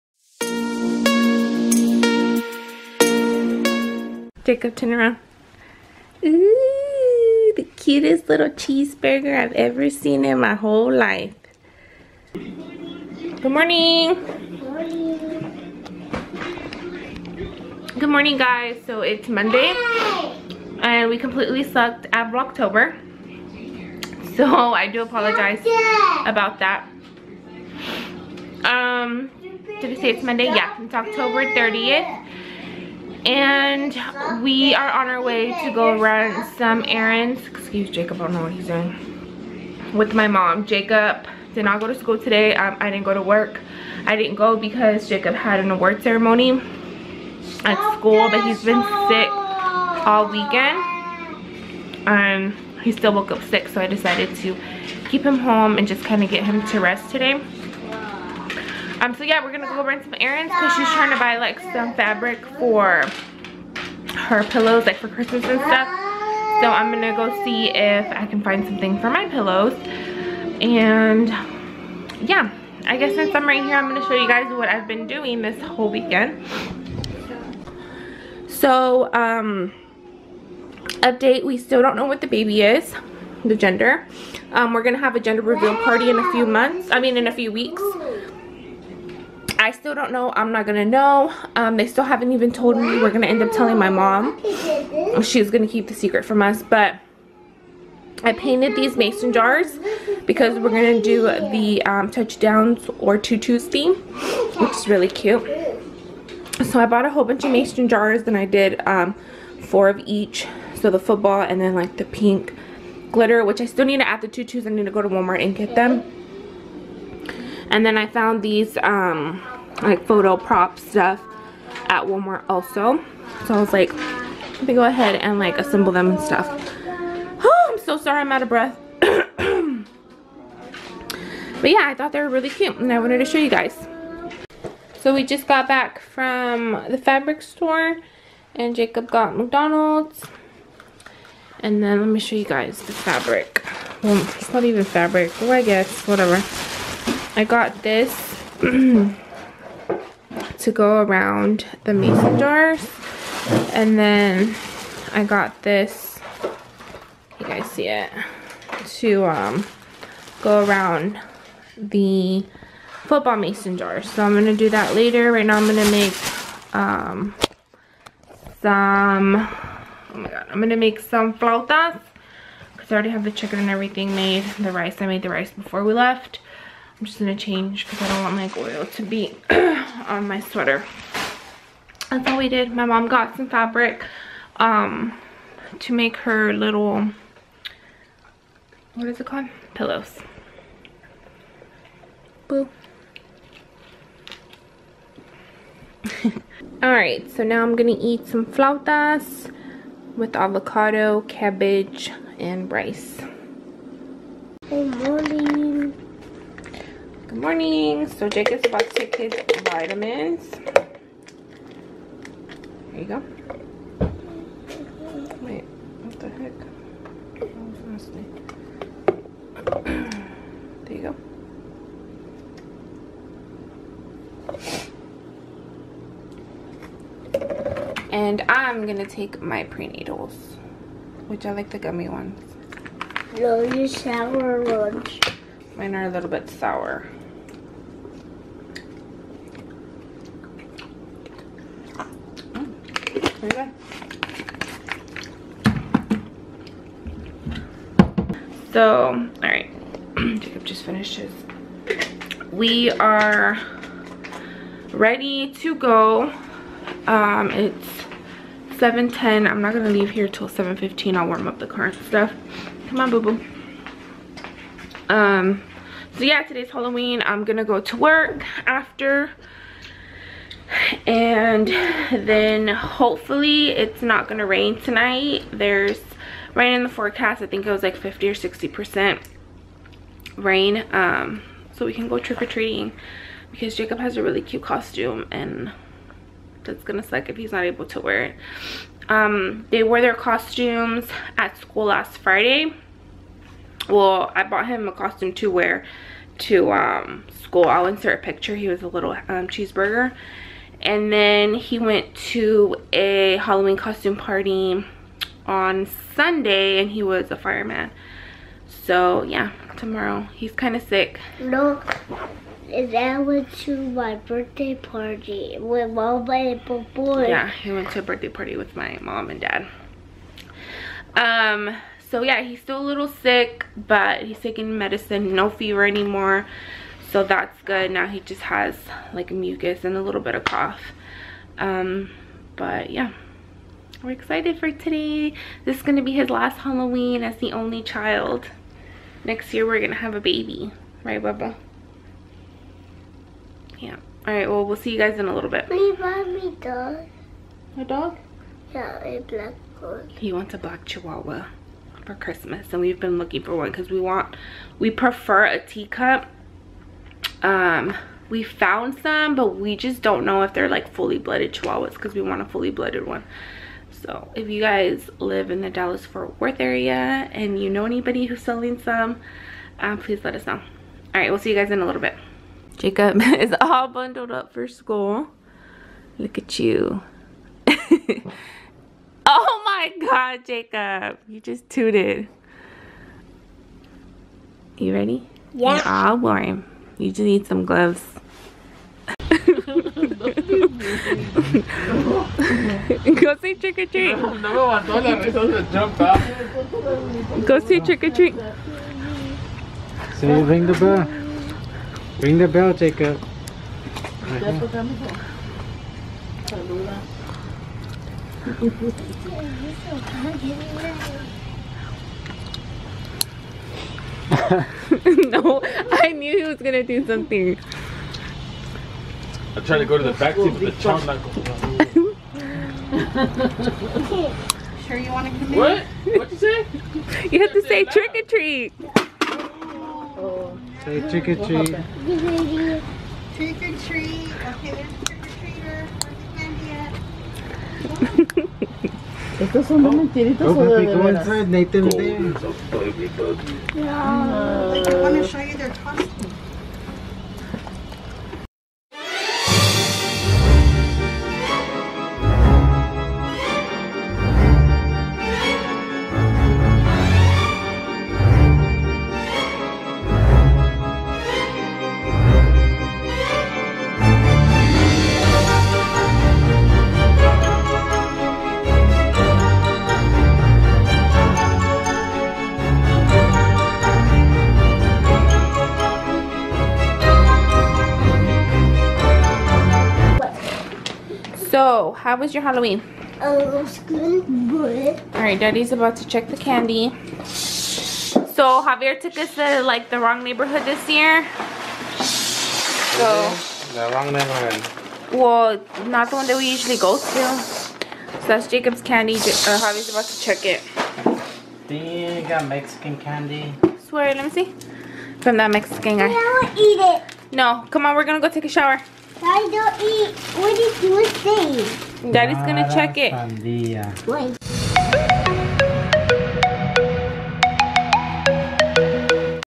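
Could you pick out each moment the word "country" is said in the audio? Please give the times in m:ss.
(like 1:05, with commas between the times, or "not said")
not said.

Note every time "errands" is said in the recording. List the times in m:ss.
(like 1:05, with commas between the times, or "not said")
0:36, 1:00.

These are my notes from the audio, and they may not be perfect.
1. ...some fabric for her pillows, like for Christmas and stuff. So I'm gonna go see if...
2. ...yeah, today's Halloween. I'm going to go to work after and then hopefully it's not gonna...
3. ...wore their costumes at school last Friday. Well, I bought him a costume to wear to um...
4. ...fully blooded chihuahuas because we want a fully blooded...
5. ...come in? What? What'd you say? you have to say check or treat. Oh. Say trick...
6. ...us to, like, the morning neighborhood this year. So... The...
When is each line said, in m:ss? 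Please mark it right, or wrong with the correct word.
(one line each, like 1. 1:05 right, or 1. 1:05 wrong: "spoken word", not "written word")
1. 1:01 right
2. 4:26 right
3. 4:49 right
4. 6:00 right
5. 7:05 wrong: "trick", not "check"
6. 8:09 wrong: "wrong", not "morning".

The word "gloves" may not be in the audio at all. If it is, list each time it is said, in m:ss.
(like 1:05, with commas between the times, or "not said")
6:27.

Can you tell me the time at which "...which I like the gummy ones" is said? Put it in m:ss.
3:51.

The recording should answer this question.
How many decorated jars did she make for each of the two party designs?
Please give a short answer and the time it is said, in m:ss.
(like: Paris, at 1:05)
4, at 1:49.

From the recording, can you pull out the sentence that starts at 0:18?
So it's Monday, and we completely sucked at Vlogtober.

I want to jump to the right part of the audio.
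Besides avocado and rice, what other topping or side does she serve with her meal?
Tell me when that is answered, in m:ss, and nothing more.
3:21.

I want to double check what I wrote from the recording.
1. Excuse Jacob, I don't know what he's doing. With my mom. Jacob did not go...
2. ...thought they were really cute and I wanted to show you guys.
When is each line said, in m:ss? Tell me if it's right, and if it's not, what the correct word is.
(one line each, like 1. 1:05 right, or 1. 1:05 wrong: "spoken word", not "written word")
1. 0:37 right
2. 2:11 right.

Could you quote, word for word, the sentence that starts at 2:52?
Because I already have the chicken and everything made.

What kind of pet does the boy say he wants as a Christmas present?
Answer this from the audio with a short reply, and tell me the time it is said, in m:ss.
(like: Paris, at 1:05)
Black chihuahua, at 5:50.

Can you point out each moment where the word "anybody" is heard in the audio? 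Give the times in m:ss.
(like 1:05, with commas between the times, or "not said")
6:07.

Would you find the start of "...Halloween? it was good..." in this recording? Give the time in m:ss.
8:02.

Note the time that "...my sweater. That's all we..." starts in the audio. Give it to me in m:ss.
3:00.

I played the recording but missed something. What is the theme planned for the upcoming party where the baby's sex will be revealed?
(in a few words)
Touchdowns or tutus.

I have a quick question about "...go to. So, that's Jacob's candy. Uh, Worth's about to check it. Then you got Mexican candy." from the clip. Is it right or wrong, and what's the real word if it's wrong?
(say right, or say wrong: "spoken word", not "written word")
wrong: "Javier", not "Worth".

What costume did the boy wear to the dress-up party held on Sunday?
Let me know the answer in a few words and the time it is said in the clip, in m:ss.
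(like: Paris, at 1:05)
Fireman, at 5:07.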